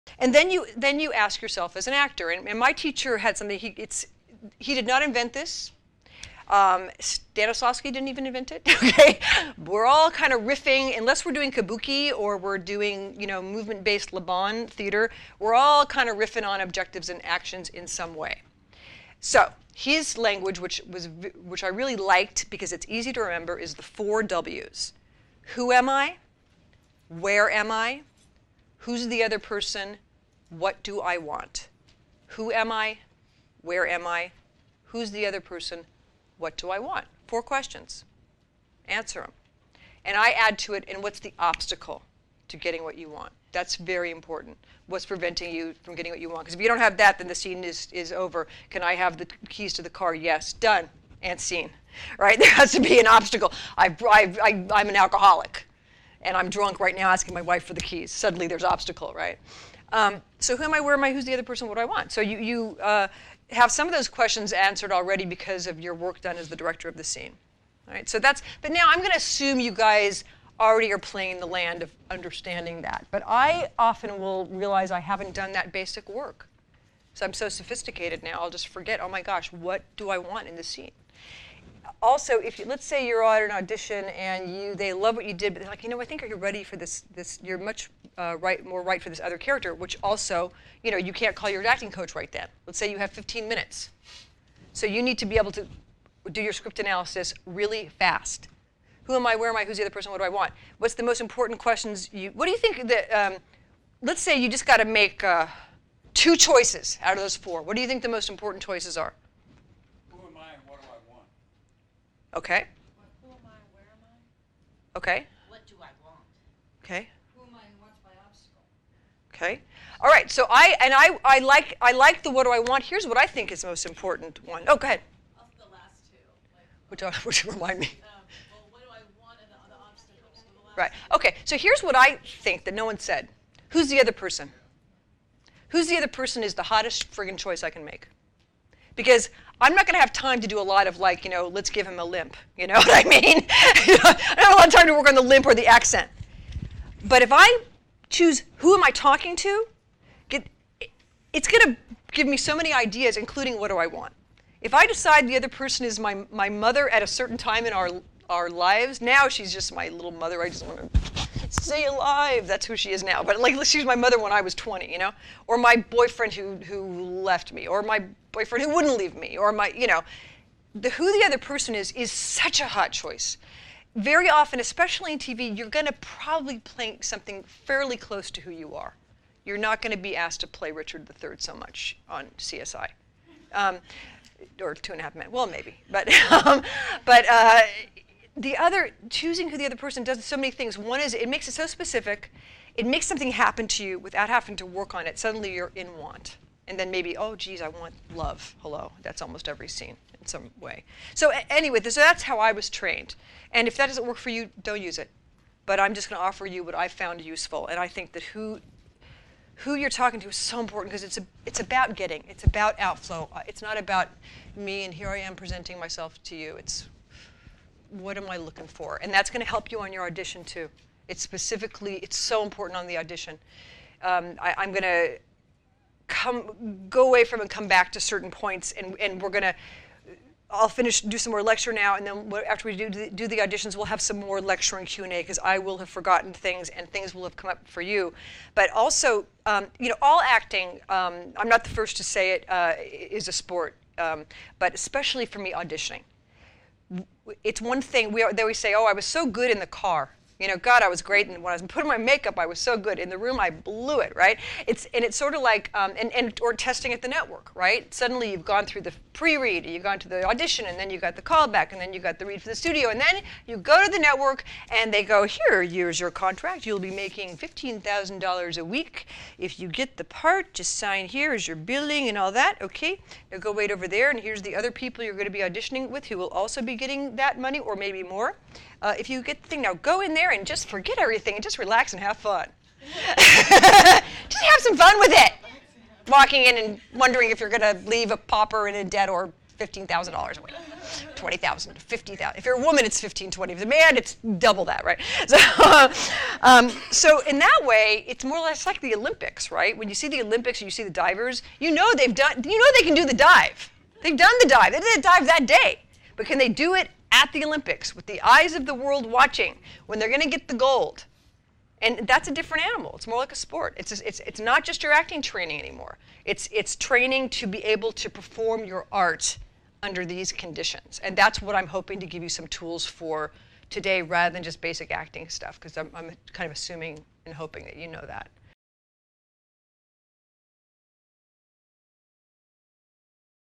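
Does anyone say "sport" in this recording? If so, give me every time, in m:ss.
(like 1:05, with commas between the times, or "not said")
4:03, 5:13.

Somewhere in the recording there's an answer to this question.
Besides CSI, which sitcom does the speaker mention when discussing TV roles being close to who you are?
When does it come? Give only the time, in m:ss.
3:04.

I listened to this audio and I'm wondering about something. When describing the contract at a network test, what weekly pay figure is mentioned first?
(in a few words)
$15,000.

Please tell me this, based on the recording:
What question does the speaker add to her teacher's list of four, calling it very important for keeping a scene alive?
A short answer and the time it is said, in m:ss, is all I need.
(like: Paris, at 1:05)
what's the obstacle, at 0:41.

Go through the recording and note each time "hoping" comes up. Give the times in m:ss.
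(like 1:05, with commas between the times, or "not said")
5:21, 5:27.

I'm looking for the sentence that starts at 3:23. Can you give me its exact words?
And if that doesn't work for you, don't use it.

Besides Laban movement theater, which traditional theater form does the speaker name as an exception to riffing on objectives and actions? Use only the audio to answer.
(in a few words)
kabuki.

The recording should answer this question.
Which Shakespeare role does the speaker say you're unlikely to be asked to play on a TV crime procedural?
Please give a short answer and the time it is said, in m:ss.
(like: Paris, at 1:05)
Richard III, at 3:00.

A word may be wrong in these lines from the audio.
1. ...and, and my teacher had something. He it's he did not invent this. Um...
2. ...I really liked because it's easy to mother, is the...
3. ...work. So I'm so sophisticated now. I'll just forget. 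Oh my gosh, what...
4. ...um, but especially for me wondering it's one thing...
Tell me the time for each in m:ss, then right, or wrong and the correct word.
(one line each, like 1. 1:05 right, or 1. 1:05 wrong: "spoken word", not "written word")
1. 0:02 right
2. 0:21 wrong: "remember", not "mother"
3. 1:16 right
4. 4:03 wrong: "auditioning", not "wondering".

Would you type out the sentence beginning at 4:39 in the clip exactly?
Now go in there there and just forget everything and just relax and have fun.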